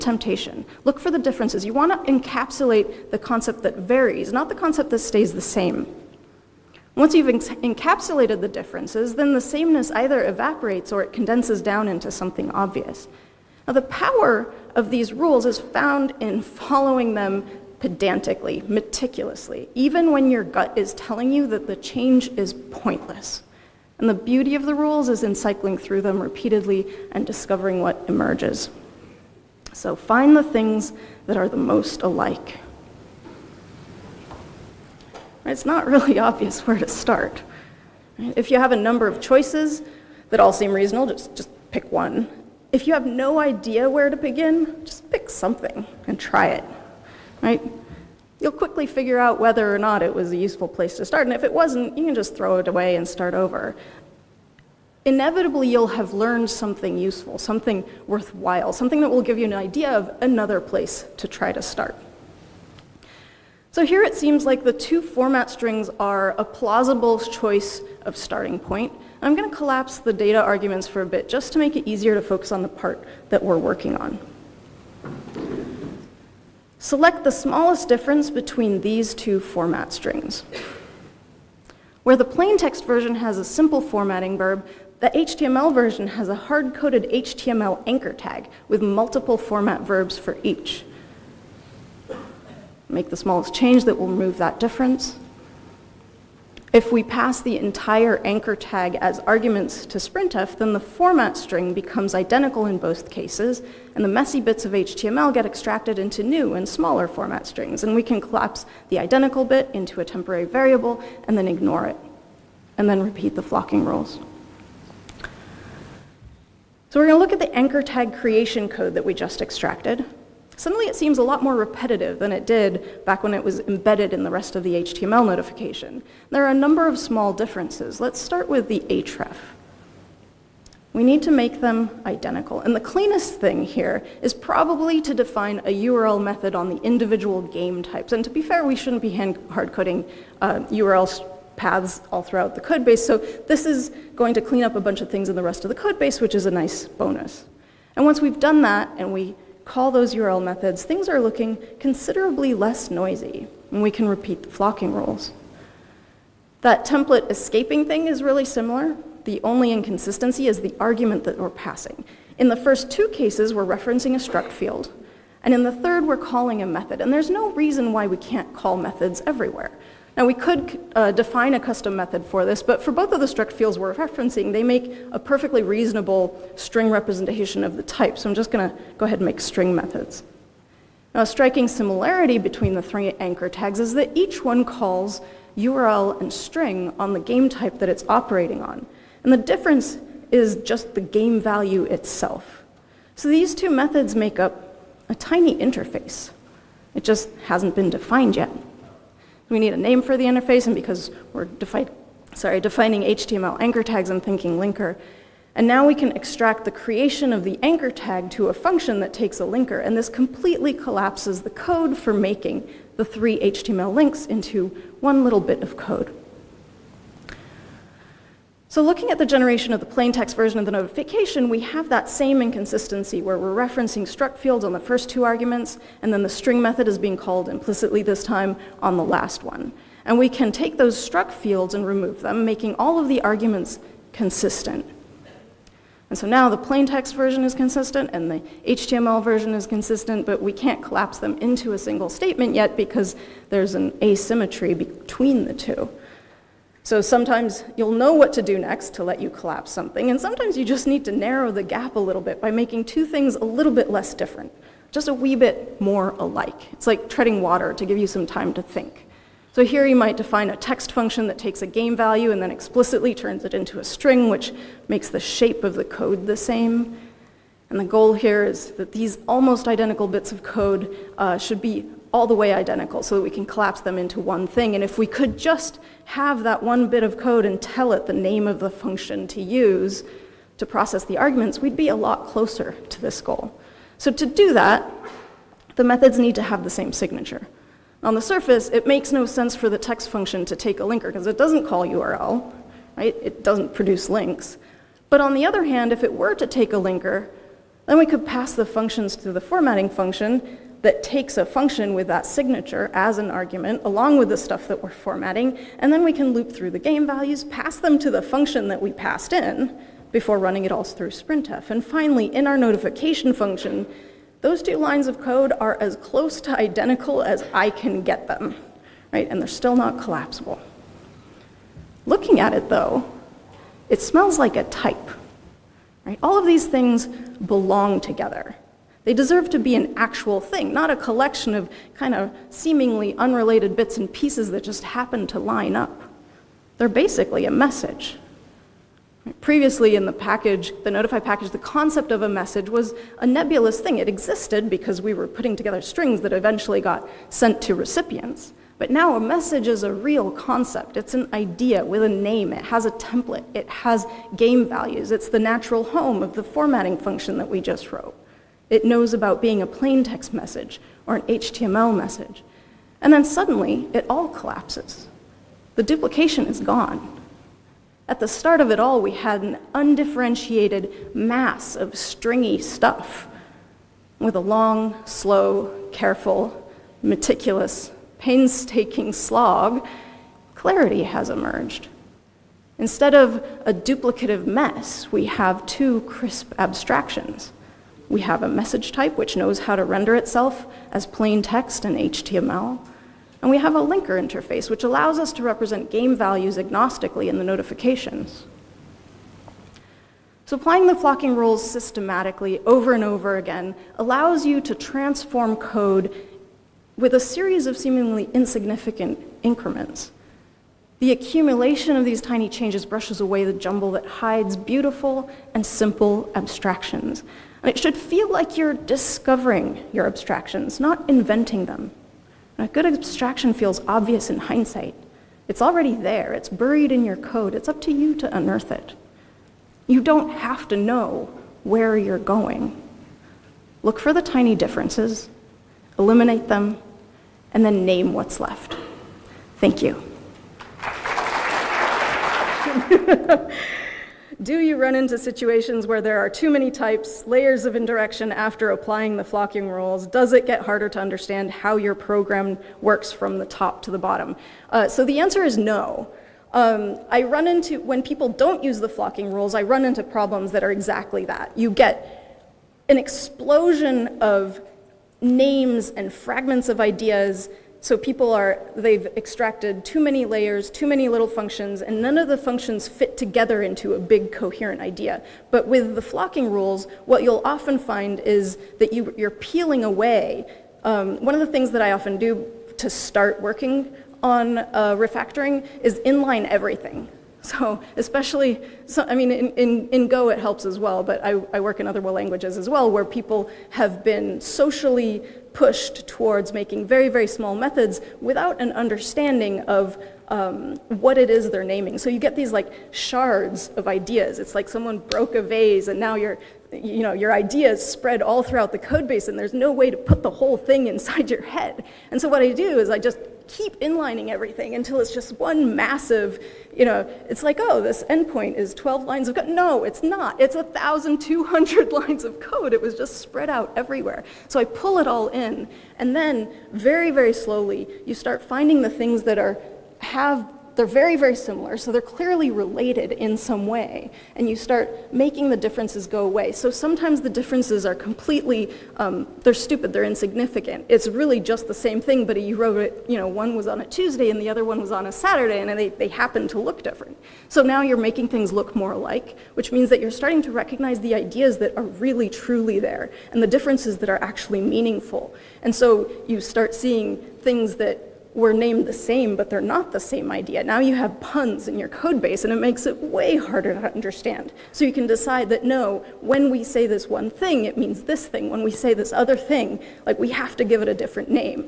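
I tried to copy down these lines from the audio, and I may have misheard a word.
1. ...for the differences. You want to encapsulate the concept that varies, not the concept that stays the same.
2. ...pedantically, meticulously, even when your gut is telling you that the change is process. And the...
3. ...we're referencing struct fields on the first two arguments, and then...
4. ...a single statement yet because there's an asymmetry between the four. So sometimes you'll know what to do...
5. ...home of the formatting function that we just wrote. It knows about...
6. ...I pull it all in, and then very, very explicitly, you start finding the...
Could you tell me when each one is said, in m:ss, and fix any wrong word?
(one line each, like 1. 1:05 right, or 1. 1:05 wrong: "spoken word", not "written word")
1. 0:00 right
2. 0:17 wrong: "pointless", not "process"
3. 3:43 right
4. 4:01 wrong: "two", not "four"
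5. 5:55 right
6. 8:44 wrong: "slowly", not "explicitly".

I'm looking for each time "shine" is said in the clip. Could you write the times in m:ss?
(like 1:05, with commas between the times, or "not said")
not said.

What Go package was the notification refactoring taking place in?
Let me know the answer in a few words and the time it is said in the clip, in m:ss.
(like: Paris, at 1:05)
Notify, at 5:40.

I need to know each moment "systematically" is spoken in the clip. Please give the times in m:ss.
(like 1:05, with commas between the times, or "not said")
6:41.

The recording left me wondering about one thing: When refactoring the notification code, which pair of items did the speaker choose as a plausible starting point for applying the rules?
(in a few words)
the two format strings.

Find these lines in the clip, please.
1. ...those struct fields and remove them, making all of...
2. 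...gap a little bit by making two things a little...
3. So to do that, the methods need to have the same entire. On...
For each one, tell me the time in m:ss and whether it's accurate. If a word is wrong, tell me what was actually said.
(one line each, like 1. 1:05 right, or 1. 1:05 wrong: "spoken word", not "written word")
1. 3:50 right
2. 4:11 right
3. 4:43 wrong: "signature", not "entire".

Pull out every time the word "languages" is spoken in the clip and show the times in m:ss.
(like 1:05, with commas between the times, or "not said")
8:11.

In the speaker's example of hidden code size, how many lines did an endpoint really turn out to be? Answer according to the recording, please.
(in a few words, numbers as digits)
1,200.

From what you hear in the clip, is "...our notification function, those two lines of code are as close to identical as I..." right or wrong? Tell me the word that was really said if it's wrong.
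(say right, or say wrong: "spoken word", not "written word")
right.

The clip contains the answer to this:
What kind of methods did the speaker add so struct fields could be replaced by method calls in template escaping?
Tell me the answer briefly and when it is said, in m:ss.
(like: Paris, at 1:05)
string methods, at 2:59.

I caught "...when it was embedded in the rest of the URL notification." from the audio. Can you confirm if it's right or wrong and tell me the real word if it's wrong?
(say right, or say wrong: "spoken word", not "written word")
wrong: "HTML", not "URL".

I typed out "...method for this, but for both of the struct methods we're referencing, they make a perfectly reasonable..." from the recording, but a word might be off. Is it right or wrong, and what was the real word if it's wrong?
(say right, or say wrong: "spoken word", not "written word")
wrong: "fields", not "methods".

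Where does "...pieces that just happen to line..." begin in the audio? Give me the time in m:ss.
5:34.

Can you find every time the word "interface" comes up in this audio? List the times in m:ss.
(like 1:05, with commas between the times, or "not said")
3:15, 3:20, 6:34.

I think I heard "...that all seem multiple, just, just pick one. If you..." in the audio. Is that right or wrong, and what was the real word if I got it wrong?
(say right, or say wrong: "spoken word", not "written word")
wrong: "reasonable", not "multiple".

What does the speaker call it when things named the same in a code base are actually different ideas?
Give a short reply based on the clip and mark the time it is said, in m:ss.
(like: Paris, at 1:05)
puns, at 9:21.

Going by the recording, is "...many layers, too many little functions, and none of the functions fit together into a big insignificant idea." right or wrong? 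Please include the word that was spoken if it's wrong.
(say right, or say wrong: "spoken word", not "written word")
wrong: "coherent", not "insignificant".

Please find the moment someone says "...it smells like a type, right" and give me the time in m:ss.
5:23.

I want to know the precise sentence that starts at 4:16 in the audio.
It's like treading water to give you some time to think.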